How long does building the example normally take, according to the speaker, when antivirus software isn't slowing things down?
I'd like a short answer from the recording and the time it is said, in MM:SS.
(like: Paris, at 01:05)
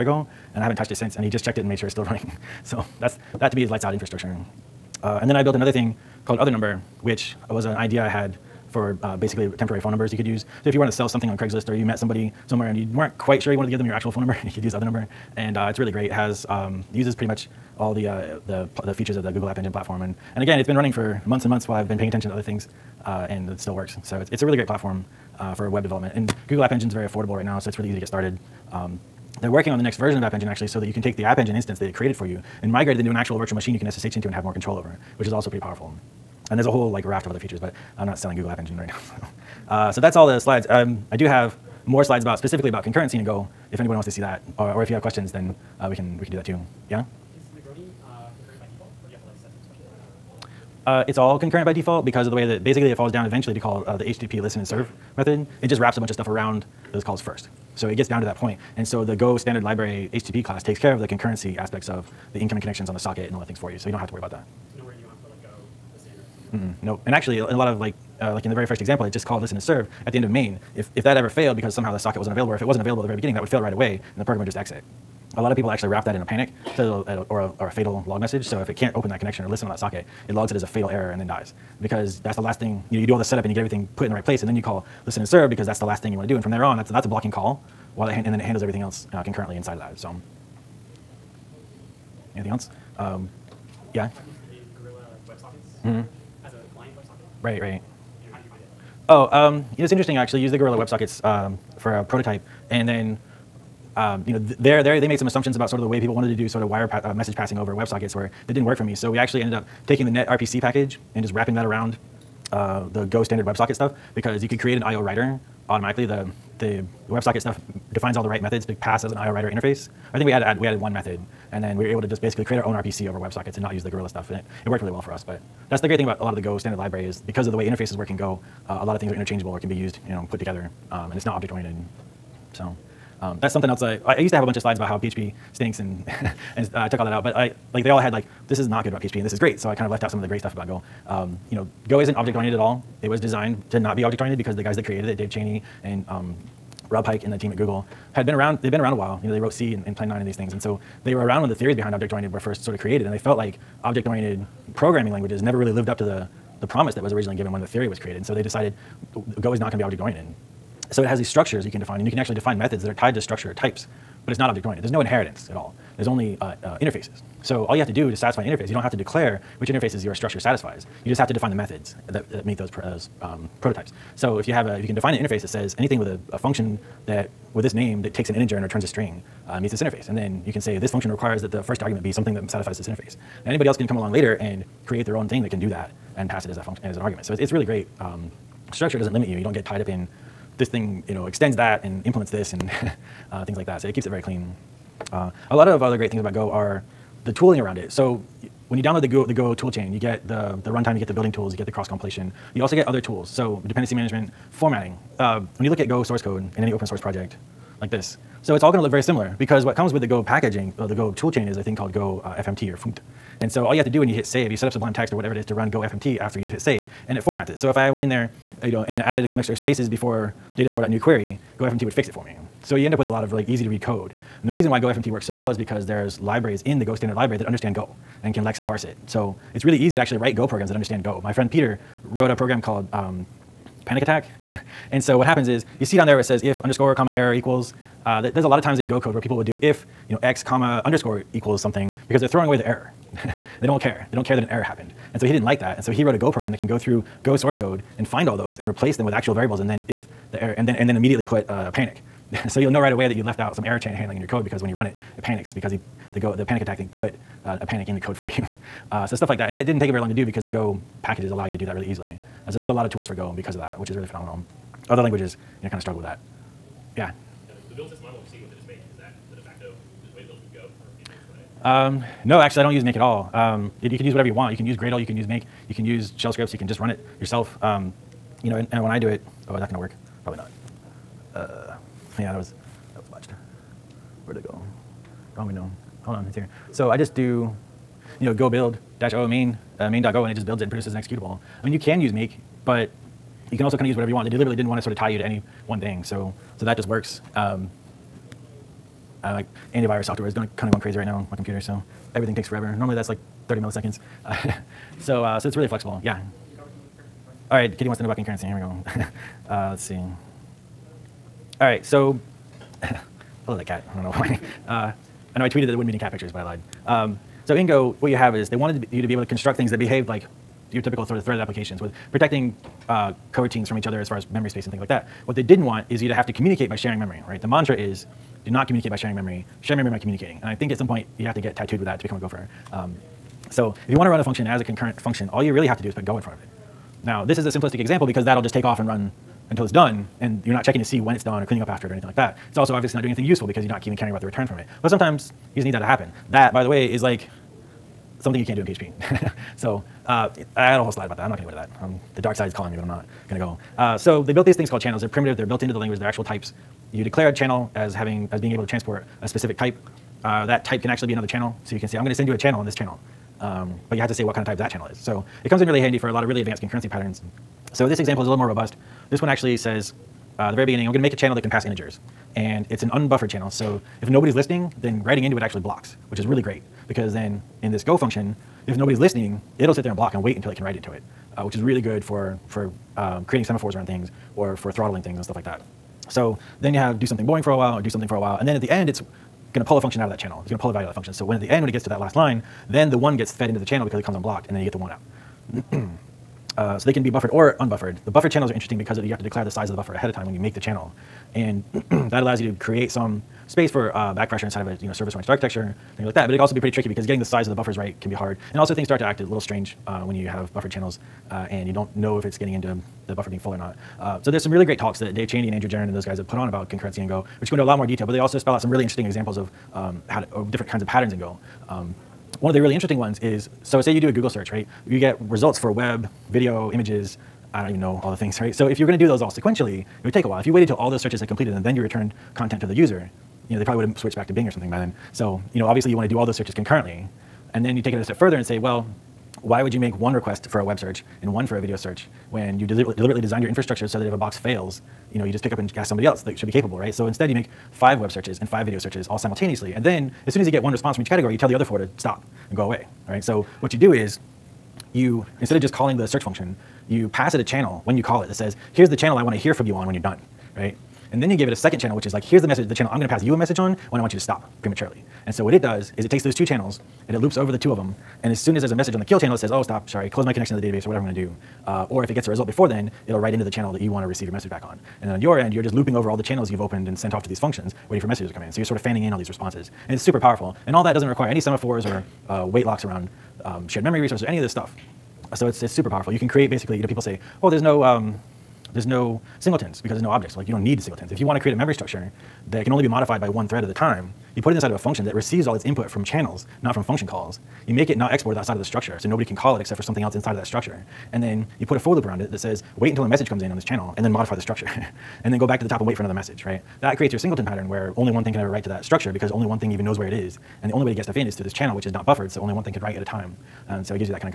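30 milliseconds, at 05:03.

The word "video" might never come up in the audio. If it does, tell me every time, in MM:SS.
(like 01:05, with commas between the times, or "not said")
07:06, 07:21, 07:28.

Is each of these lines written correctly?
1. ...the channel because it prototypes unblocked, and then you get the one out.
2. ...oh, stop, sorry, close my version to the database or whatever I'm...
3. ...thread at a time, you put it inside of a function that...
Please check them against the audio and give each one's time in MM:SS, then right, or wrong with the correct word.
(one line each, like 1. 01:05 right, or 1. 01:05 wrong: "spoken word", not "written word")
1. 06:33 wrong: "comes", not "prototypes"
2. 07:49 wrong: "connection", not "version"
3. 08:13 right.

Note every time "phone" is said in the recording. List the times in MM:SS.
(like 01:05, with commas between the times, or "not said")
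00:09, 00:14.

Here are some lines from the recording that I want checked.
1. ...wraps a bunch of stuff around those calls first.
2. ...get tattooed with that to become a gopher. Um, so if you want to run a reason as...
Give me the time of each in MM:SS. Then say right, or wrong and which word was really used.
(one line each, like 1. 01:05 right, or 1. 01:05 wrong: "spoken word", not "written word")
1. 00:55 right
2. 05:31 wrong: "function", not "reason".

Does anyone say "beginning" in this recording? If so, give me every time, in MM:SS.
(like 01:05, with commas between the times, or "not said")
01:13, 06:10.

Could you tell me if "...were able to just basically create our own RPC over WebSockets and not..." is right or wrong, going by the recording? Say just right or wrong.
right.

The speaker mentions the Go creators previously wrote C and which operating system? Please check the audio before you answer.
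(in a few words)
Plan 9.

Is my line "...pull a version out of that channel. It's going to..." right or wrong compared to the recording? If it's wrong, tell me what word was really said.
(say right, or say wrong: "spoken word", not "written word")
wrong: "function", not "version".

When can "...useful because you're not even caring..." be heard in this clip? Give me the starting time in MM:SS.
05:43.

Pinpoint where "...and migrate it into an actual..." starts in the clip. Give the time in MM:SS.
00:32.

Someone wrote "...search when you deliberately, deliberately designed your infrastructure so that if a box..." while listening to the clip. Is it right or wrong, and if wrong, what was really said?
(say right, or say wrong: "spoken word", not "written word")
right.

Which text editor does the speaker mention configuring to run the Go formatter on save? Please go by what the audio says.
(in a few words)
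Sublime Text.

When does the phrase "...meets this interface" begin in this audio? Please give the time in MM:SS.
02:59.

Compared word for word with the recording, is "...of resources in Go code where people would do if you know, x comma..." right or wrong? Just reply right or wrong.
wrong.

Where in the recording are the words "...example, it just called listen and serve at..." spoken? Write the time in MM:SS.
01:08.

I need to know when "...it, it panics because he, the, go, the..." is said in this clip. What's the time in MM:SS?
04:14.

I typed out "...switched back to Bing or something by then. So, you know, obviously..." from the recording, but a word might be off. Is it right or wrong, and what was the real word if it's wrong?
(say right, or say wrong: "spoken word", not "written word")
right.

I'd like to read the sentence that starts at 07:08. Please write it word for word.
So if you're gonna do those all sequentially, it would take a while.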